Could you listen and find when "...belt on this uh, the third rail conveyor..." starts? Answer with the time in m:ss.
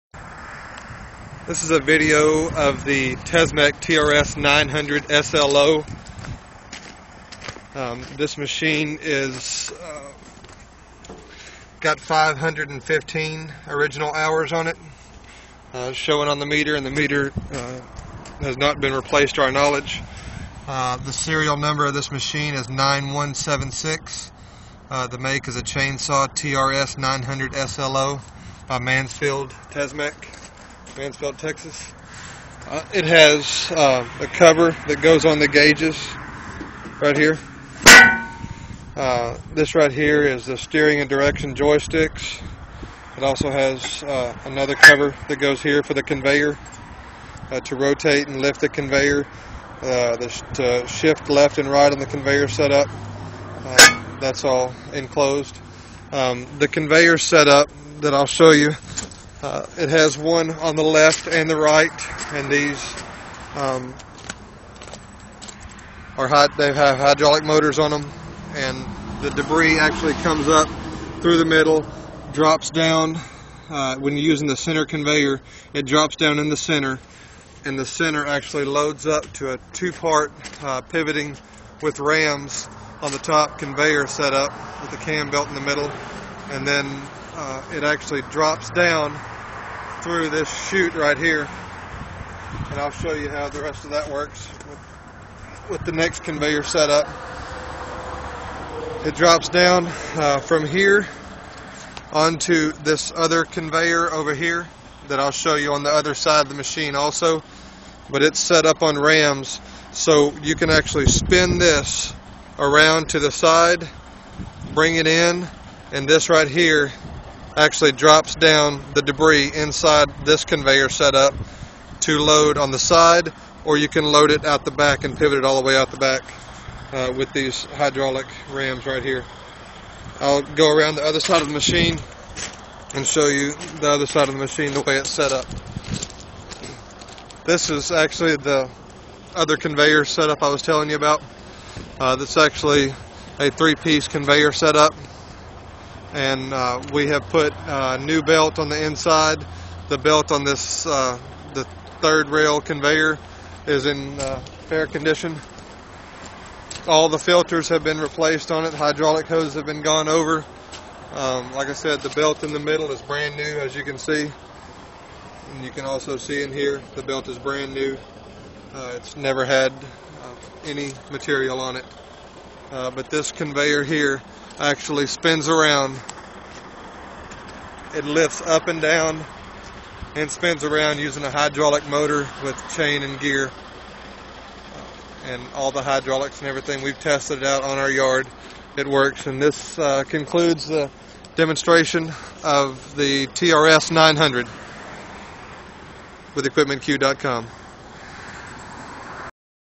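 2:29.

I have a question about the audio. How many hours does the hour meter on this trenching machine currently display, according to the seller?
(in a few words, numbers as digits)
515.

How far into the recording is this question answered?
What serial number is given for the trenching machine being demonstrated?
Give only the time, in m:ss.
0:22.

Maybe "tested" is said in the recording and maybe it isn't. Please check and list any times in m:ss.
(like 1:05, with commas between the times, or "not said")
3:06.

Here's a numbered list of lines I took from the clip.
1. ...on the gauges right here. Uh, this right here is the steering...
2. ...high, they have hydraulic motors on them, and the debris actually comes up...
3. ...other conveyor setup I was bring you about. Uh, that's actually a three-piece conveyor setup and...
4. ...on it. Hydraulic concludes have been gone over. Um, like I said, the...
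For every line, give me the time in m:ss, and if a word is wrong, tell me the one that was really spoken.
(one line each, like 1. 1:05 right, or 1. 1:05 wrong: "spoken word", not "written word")
1. 0:35 right
2. 1:06 right
3. 2:19 wrong: "telling", not "bring"
4. 2:38 wrong: "hoses", not "concludes".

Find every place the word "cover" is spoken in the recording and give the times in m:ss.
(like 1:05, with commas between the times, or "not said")
0:34, 0:44.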